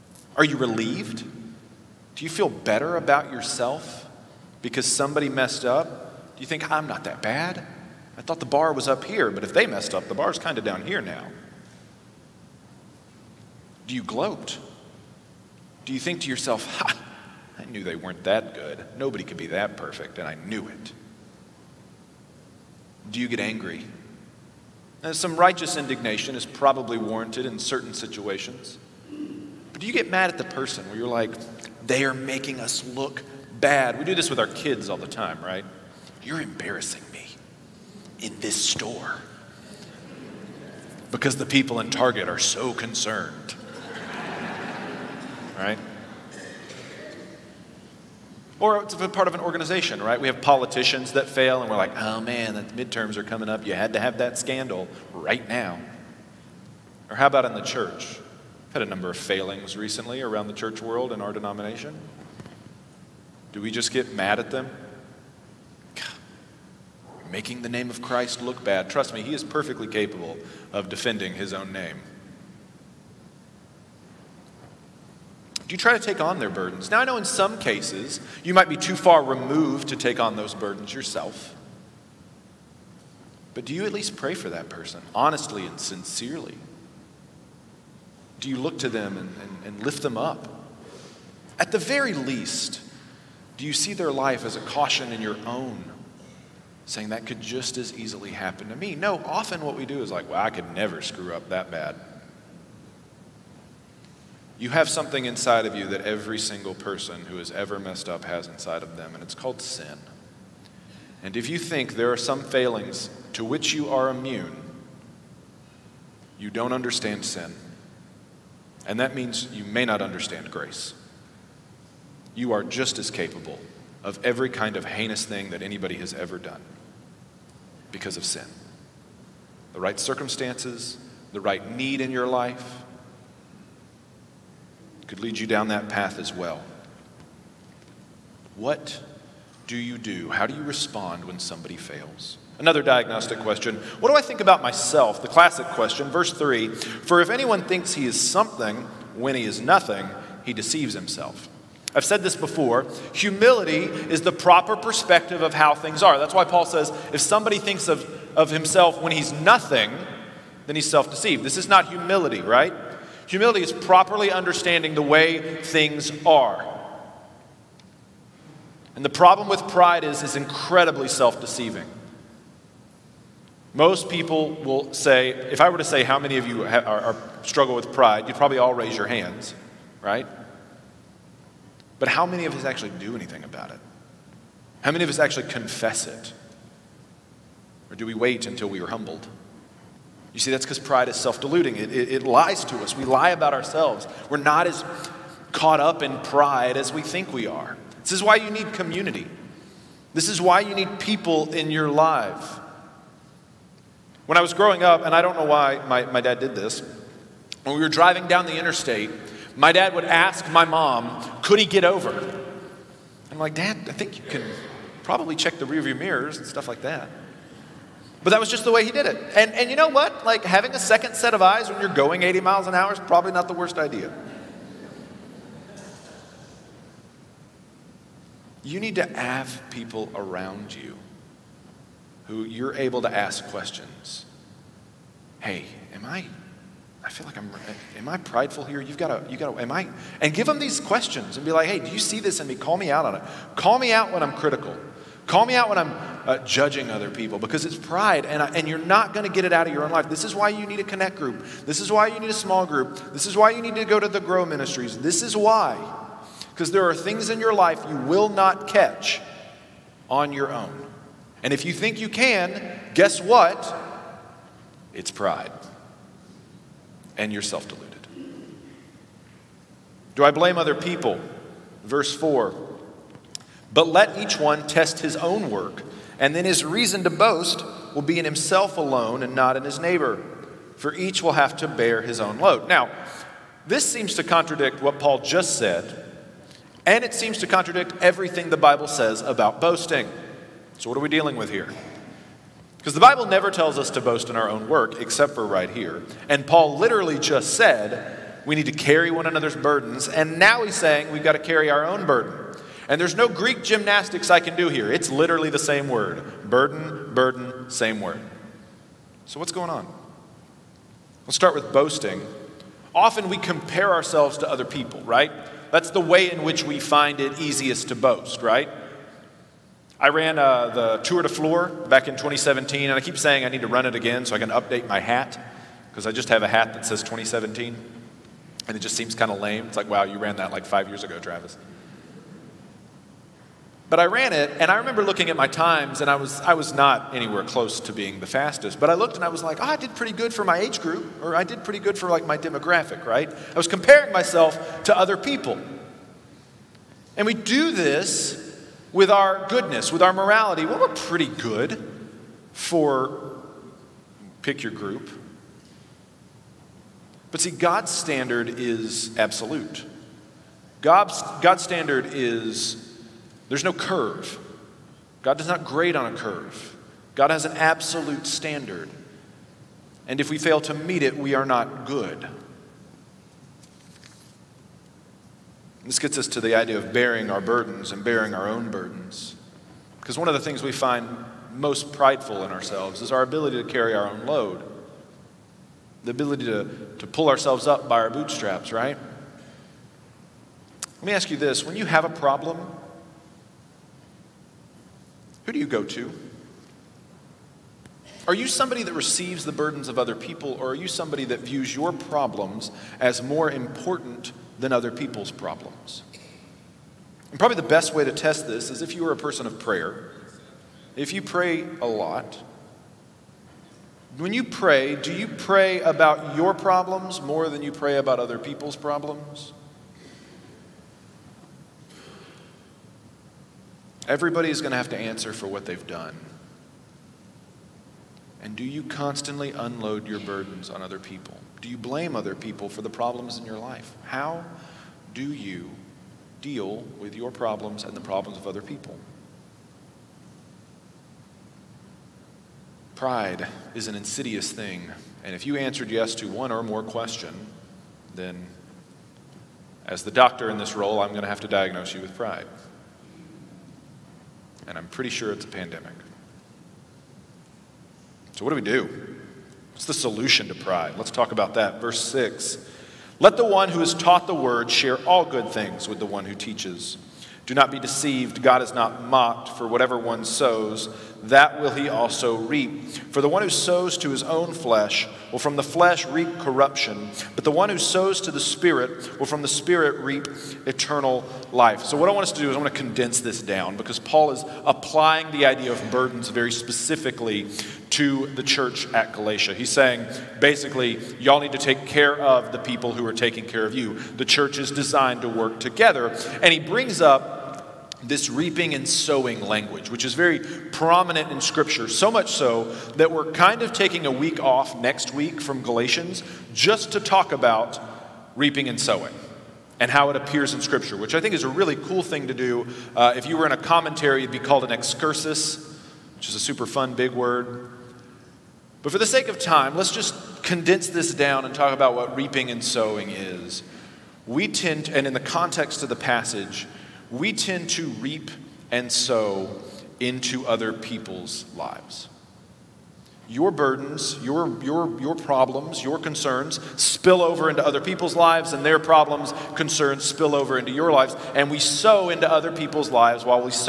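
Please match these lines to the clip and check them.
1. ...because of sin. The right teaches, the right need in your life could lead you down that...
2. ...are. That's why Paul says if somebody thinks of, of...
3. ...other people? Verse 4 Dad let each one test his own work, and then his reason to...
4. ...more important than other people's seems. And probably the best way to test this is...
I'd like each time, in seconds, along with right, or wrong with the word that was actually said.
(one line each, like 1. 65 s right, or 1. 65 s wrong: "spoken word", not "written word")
1. 127 s wrong: "circumstances", not "teaches"
2. 156 s right
3. 270 s wrong: "But", not "Dad"
4. 403 s wrong: "problems", not "seems".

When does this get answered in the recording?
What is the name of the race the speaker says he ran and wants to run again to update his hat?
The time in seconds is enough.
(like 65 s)
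320 s.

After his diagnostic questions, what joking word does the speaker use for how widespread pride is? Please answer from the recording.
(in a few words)
pandemic.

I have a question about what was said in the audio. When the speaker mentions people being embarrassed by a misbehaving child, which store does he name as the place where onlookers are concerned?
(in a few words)
Target.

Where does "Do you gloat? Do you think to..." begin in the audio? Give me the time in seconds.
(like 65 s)
13 s.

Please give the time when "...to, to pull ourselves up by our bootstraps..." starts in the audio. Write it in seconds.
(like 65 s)
386 s.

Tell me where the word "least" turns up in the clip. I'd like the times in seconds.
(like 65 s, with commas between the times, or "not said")
83 s, 92 s.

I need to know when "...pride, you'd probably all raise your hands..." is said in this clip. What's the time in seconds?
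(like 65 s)
177 s.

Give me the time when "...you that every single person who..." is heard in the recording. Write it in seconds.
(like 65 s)
105 s.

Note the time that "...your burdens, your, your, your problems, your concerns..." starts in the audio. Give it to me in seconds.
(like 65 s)
533 s.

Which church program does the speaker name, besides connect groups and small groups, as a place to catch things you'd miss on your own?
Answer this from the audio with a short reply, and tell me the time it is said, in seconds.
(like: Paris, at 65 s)
Grow Ministries, at 254 s.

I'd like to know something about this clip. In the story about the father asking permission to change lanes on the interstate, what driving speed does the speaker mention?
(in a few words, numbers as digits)
80 miles an hour.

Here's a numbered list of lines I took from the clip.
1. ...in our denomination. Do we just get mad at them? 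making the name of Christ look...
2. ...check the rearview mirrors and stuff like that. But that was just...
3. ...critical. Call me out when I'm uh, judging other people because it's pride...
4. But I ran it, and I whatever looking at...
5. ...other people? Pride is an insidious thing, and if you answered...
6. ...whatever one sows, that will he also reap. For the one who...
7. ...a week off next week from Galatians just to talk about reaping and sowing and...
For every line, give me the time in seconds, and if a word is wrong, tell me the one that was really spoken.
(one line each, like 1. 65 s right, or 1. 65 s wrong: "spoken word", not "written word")
1. 61 s right
2. 215 s right
3. 244 s right
4. 333 s wrong: "remember", not "whatever"
5. 438 s right
6. 469 s right
7. 504 s right.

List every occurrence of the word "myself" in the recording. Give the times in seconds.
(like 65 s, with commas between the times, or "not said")
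144 s, 344 s.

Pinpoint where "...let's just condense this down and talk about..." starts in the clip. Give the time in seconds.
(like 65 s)
519 s.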